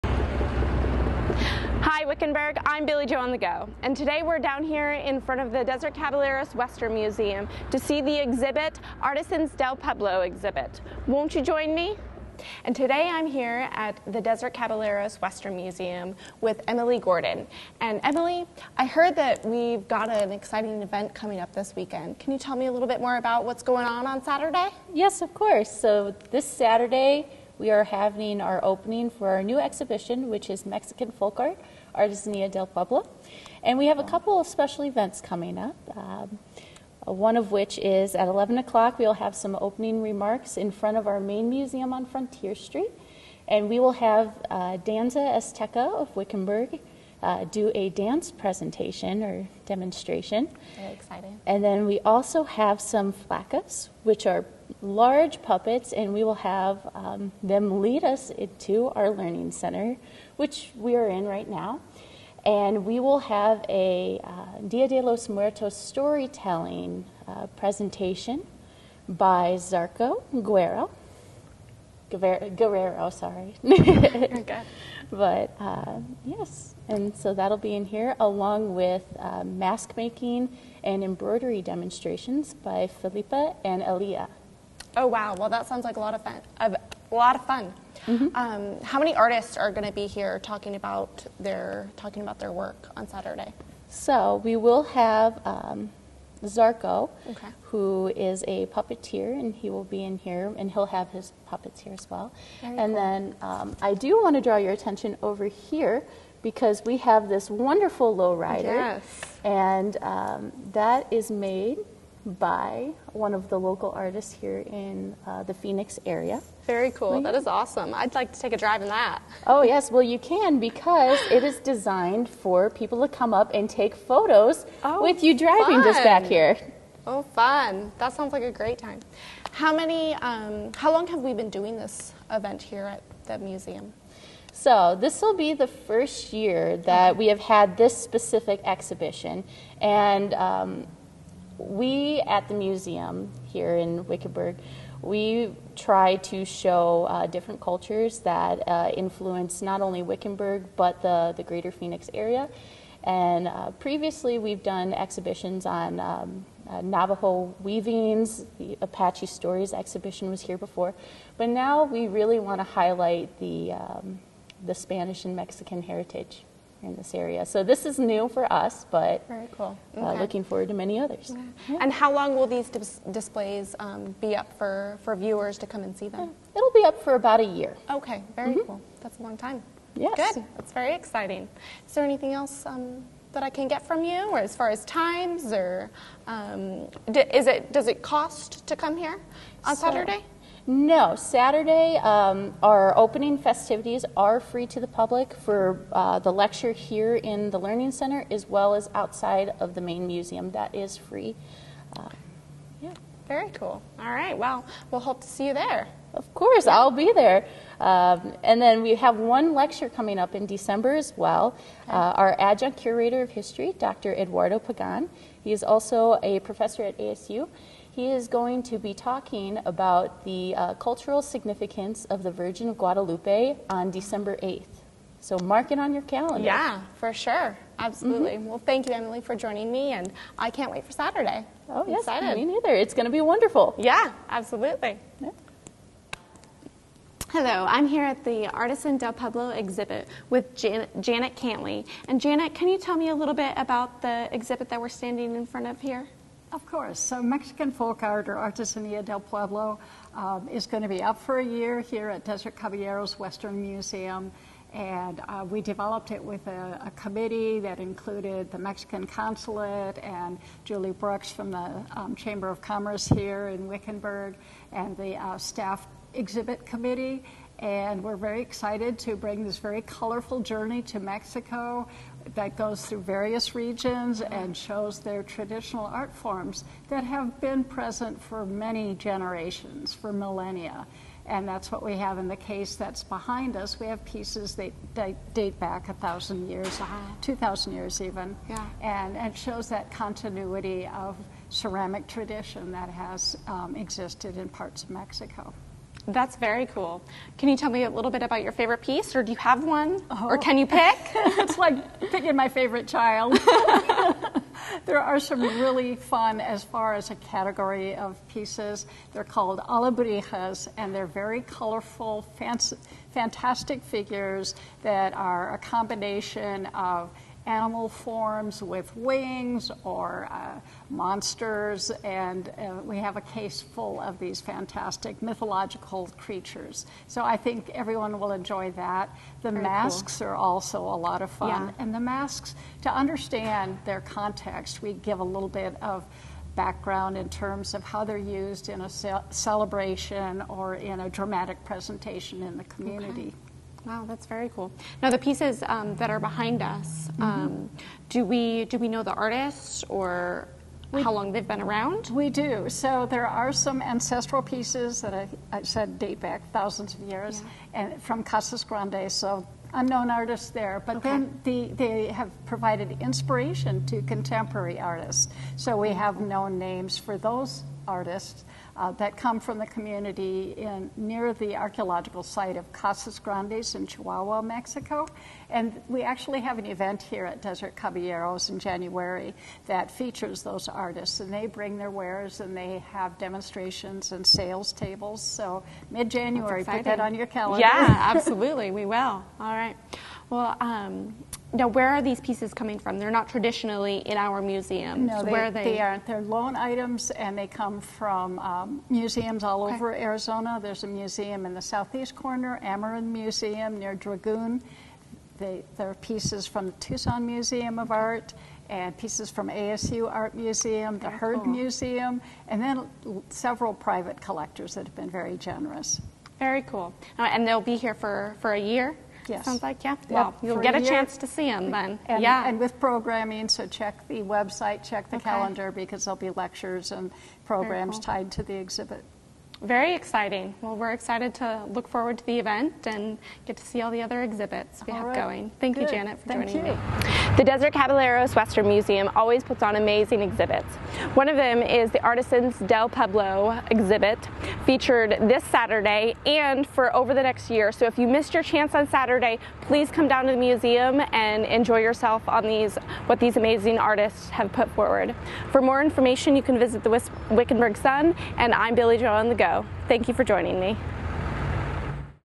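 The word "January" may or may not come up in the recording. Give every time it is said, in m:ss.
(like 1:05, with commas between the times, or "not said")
6:18, 6:26.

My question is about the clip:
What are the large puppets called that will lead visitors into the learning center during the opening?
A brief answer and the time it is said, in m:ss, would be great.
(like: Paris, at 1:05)
flacas, at 0:53.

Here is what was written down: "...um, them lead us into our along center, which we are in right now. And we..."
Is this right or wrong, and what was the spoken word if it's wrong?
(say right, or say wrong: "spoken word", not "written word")
wrong: "learning", not "along".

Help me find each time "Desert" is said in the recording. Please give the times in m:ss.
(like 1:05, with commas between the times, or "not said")
0:05, 0:14, 4:12, 6:17, 7:17.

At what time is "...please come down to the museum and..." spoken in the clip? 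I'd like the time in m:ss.
7:29.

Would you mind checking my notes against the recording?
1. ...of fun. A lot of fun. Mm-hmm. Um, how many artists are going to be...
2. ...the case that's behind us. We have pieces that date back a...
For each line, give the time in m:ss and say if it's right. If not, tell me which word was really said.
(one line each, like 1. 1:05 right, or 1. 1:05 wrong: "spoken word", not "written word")
1. 1:26 right
2. 4:42 right.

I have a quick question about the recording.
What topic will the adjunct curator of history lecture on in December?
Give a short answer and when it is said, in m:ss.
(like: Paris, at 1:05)
Virgin of Guadalupe, at 3:42.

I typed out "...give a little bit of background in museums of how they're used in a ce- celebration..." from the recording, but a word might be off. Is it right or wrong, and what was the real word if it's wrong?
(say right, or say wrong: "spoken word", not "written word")
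wrong: "terms", not "museums".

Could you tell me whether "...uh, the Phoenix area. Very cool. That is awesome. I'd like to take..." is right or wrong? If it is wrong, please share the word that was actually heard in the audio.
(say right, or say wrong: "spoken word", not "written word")
right.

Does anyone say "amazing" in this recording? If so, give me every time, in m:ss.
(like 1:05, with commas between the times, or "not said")
7:19, 7:33.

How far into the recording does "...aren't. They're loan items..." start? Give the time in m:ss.
6:35.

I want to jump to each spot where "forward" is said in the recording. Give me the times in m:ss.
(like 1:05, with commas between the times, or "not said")
2:50, 7:11, 7:34.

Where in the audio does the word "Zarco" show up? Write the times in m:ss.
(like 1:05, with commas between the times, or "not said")
1:09, 1:36.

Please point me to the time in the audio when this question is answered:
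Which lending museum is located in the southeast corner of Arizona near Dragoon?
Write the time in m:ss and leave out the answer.
6:42.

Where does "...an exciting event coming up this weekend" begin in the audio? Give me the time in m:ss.
0:20.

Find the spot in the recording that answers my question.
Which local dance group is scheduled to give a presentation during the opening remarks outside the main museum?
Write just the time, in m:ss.
0:44.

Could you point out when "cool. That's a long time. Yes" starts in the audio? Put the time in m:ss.
2:58.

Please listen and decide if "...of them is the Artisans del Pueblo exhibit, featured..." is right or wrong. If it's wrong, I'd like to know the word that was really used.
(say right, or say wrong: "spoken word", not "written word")
right.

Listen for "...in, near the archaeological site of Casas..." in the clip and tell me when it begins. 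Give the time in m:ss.
6:10.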